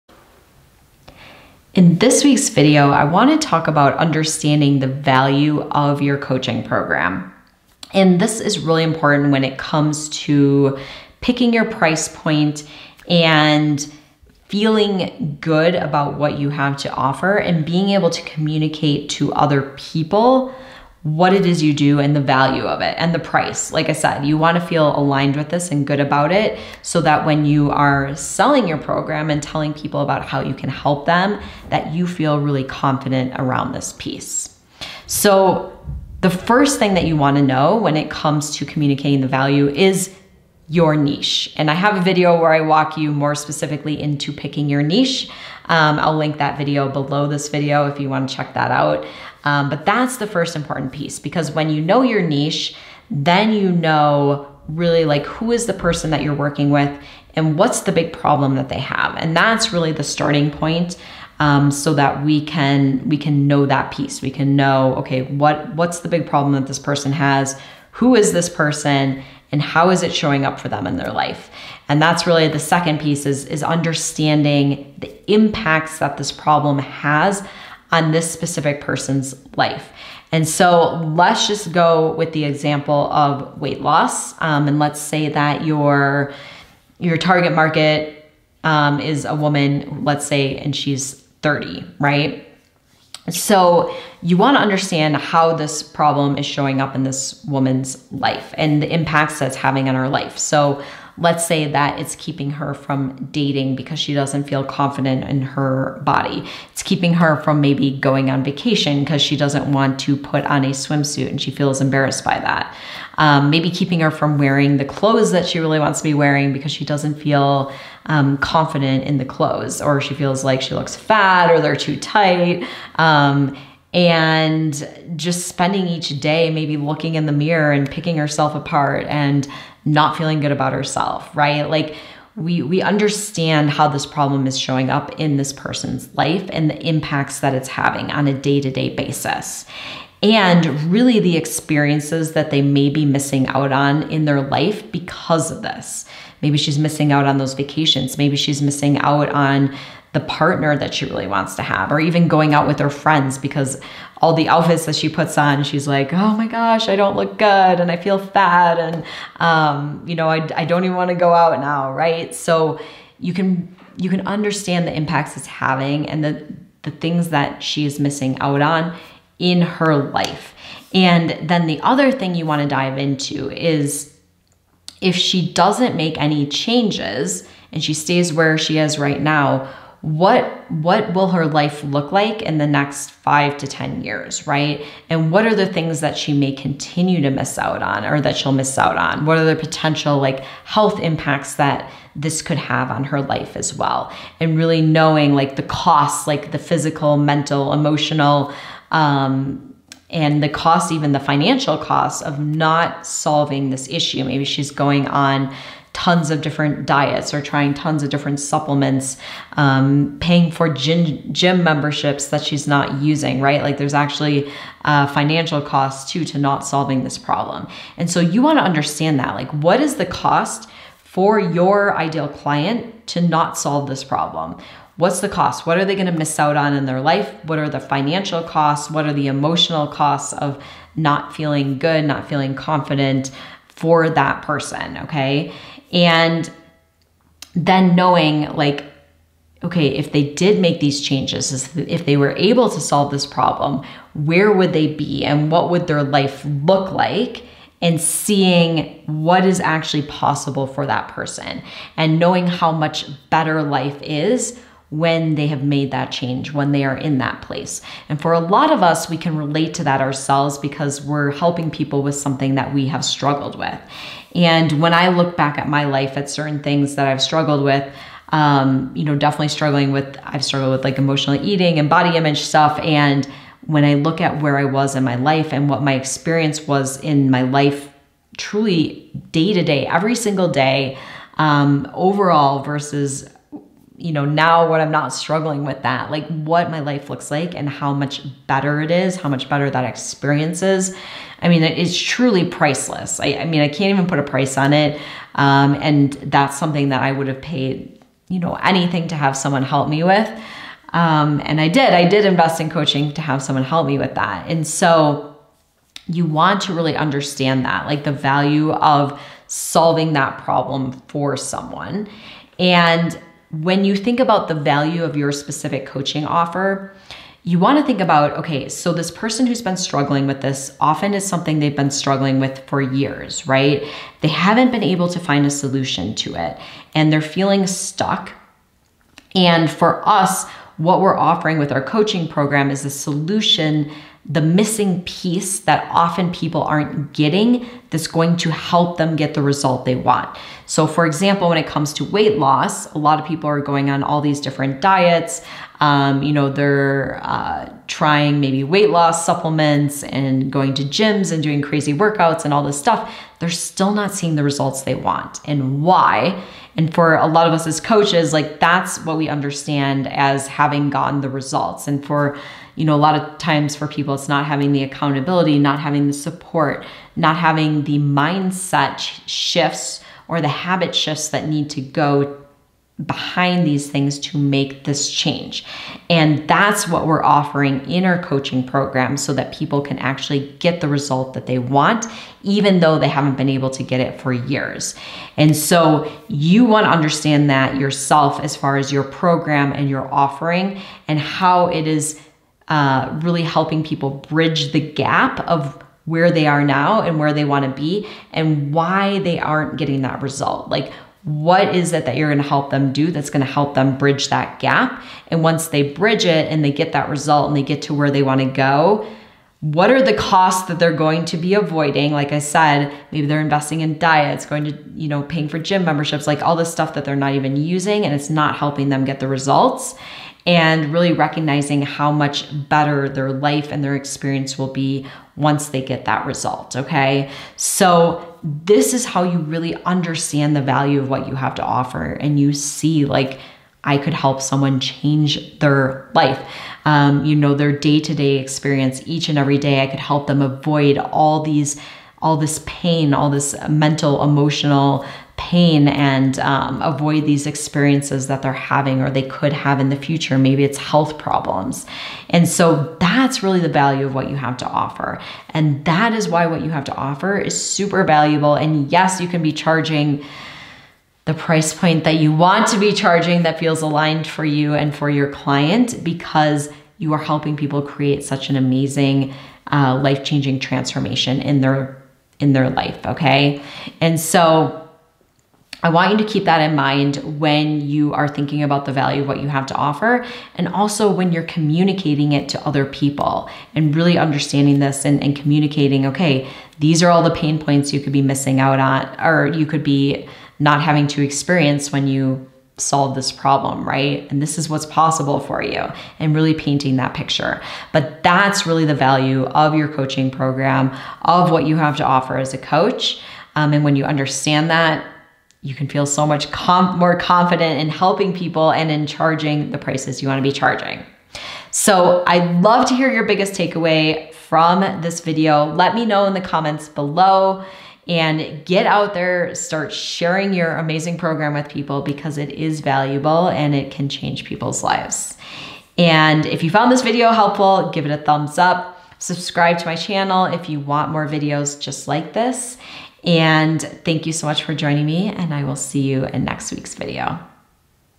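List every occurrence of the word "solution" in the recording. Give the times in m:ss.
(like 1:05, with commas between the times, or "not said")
5:25, 5:32.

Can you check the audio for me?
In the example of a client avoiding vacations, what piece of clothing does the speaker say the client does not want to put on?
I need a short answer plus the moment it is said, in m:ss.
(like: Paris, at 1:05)
swimsuit, at 1:50.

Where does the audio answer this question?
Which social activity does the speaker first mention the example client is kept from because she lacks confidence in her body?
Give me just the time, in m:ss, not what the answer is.
1:43.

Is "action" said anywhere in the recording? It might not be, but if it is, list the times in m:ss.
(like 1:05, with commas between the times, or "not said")
not said.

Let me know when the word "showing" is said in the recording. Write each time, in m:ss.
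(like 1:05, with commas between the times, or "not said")
1:10, 1:36, 2:14.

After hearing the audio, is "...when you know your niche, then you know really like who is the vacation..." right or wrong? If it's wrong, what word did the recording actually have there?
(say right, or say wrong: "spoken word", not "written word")
wrong: "person", not "vacation".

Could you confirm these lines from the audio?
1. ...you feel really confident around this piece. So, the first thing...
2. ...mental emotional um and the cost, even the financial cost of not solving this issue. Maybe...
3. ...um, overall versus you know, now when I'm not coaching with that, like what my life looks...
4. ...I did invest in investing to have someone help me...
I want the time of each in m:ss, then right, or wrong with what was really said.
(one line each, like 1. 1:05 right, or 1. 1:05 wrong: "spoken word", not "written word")
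1. 0:31 right
2. 3:17 right
3. 4:41 wrong: "struggling", not "coaching"
4. 5:01 wrong: "coaching", not "investing".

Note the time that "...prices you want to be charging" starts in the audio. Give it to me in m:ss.
8:29.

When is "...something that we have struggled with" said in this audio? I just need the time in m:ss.
4:22.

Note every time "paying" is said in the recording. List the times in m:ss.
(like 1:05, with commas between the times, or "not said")
3:30, 6:55.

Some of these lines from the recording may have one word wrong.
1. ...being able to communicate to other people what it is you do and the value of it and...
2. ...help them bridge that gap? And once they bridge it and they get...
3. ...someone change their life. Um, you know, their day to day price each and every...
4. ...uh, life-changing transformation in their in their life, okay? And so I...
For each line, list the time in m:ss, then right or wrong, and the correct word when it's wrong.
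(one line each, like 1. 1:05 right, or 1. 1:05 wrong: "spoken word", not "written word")
1. 0:17 right
2. 6:43 right
3. 7:14 wrong: "experience", not "price"
4. 7:49 right.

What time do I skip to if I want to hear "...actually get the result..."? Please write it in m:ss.
6:19.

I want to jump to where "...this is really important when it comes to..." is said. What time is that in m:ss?
0:08.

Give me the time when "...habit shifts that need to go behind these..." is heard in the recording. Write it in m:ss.
6:10.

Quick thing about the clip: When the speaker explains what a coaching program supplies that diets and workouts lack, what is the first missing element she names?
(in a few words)
accountability.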